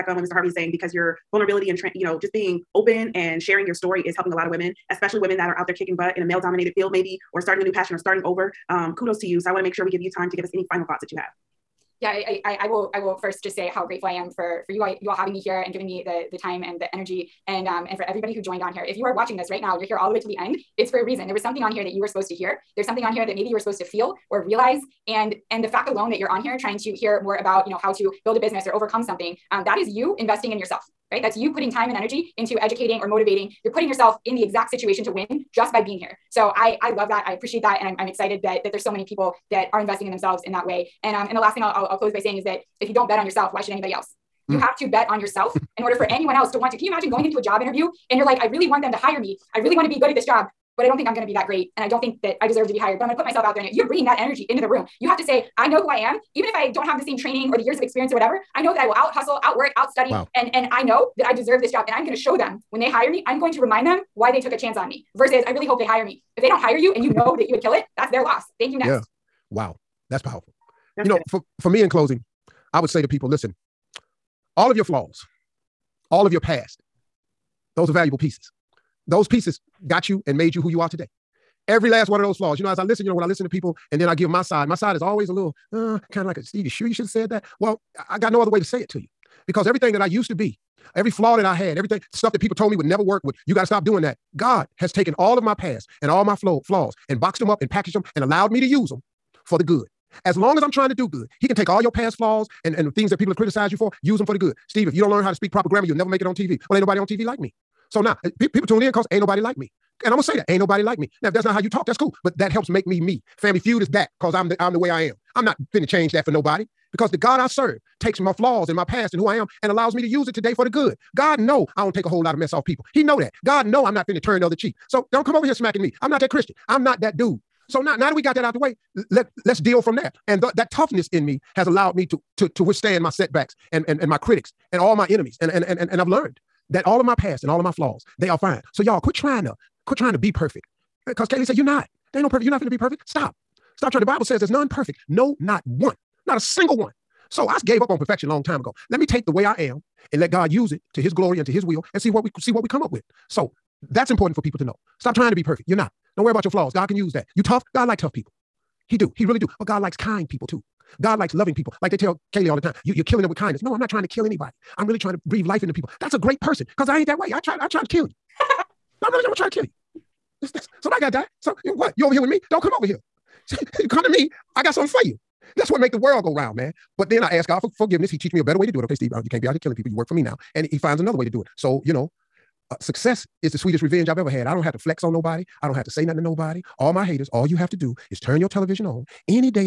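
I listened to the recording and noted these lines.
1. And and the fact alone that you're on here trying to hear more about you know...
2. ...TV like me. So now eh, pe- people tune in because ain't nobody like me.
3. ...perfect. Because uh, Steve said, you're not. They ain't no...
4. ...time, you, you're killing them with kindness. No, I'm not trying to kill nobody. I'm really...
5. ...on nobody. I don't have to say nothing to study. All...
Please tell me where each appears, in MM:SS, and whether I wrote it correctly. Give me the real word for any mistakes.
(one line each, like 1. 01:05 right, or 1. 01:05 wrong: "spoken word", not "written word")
1. 00:25 right
2. 01:47 right
3. 02:20 wrong: "Galey", not "Steve"
4. 02:42 wrong: "anybody", not "nobody"
5. 03:05 wrong: "nobody", not "study".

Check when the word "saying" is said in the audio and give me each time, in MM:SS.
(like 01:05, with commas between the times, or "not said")
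00:00, 00:42.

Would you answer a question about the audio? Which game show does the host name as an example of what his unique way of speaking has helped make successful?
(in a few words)
Family Feud.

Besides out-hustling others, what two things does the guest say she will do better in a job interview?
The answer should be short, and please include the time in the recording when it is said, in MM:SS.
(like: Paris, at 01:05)
out work, out study, at 00:59.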